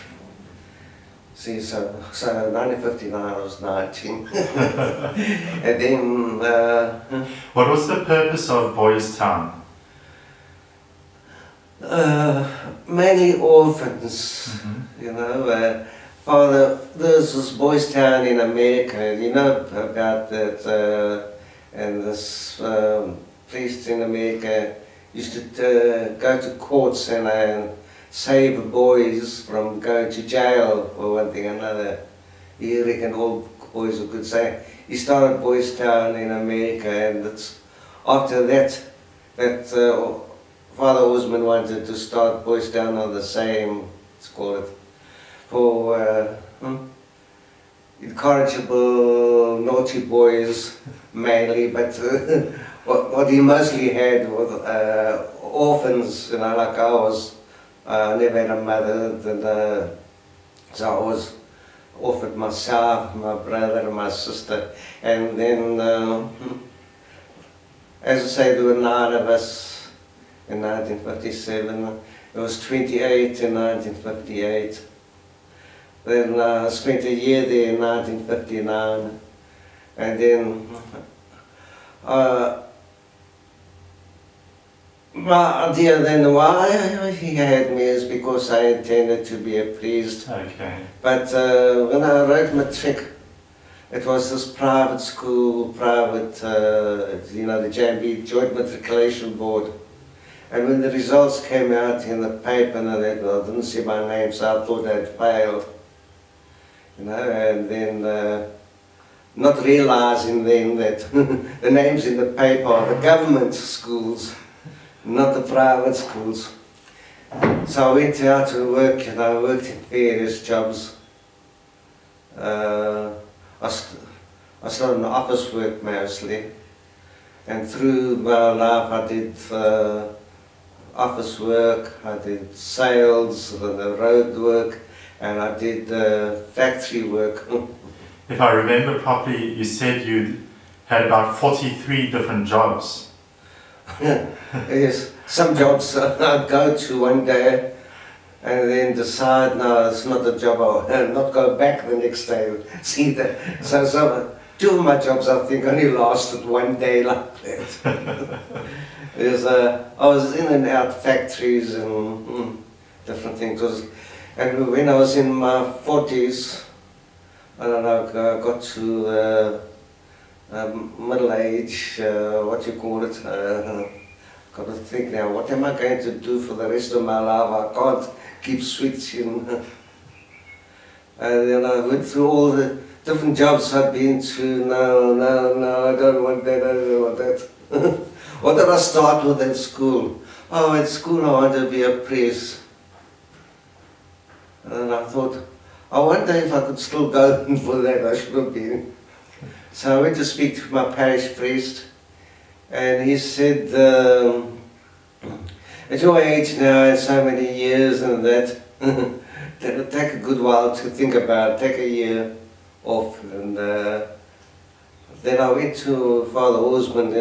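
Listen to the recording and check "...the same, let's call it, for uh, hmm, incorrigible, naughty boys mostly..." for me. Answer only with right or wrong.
wrong.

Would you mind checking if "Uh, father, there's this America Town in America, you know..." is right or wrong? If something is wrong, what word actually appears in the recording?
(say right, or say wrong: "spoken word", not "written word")
wrong: "Boys", not "America".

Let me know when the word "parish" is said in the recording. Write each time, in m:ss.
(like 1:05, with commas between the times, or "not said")
3:20.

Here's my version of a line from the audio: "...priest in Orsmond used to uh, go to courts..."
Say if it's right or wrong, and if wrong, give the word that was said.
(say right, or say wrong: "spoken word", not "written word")
wrong: "America", not "Orsmond".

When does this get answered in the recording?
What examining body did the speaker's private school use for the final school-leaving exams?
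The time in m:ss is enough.
1:38.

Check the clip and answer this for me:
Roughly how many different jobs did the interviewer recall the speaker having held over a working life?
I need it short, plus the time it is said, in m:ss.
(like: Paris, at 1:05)
43, at 2:21.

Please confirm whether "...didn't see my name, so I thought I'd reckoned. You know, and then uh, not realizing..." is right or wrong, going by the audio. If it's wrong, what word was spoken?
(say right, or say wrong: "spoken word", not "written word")
wrong: "failed", not "reckoned".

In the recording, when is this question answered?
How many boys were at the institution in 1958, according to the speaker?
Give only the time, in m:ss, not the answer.
1:12.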